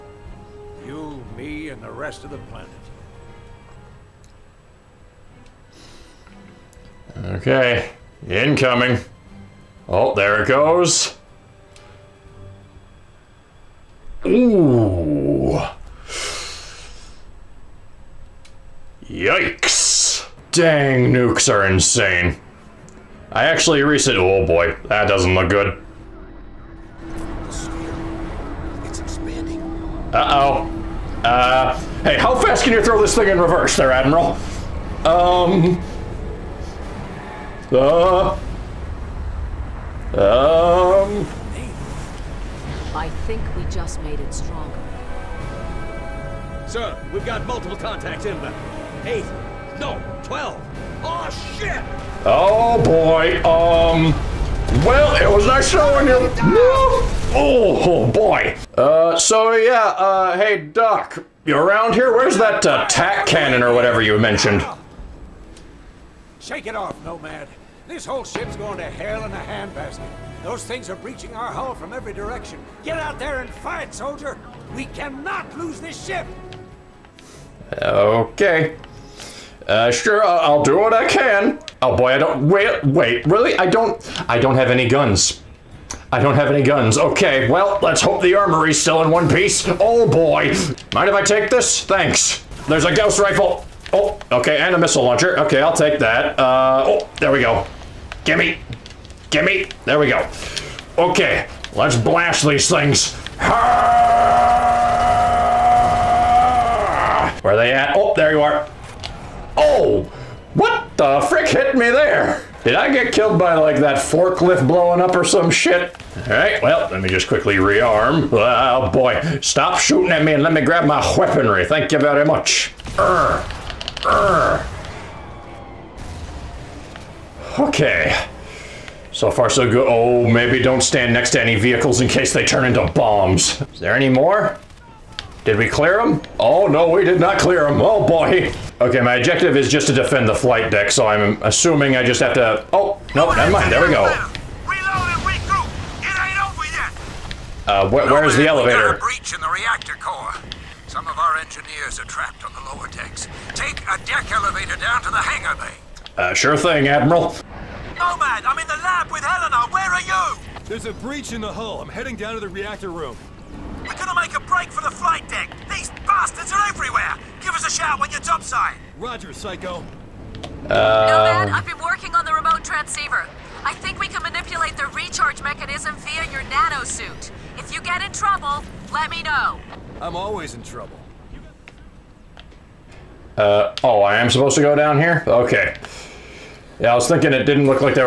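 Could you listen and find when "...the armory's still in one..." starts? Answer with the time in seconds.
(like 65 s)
88 s.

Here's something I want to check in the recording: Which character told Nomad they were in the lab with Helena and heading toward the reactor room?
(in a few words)
Psycho.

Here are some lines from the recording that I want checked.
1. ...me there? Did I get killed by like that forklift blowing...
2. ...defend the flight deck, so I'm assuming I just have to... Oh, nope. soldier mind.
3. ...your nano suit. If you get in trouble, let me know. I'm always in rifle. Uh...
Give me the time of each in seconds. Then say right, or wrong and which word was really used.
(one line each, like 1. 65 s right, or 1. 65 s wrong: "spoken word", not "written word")
1. 111 s right
2. 139 s wrong: "never", not "soldier"
3. 176 s wrong: "trouble", not "rifle".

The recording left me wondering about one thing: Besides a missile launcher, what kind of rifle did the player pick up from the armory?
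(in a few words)
Gauss rifle.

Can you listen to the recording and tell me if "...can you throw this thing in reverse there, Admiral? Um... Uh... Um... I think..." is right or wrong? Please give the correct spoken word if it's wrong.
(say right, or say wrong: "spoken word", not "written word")
right.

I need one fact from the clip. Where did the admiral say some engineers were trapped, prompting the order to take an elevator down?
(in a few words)
lower decks.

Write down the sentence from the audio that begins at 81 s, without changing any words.
Oh boy, I don't, wait, wait, really?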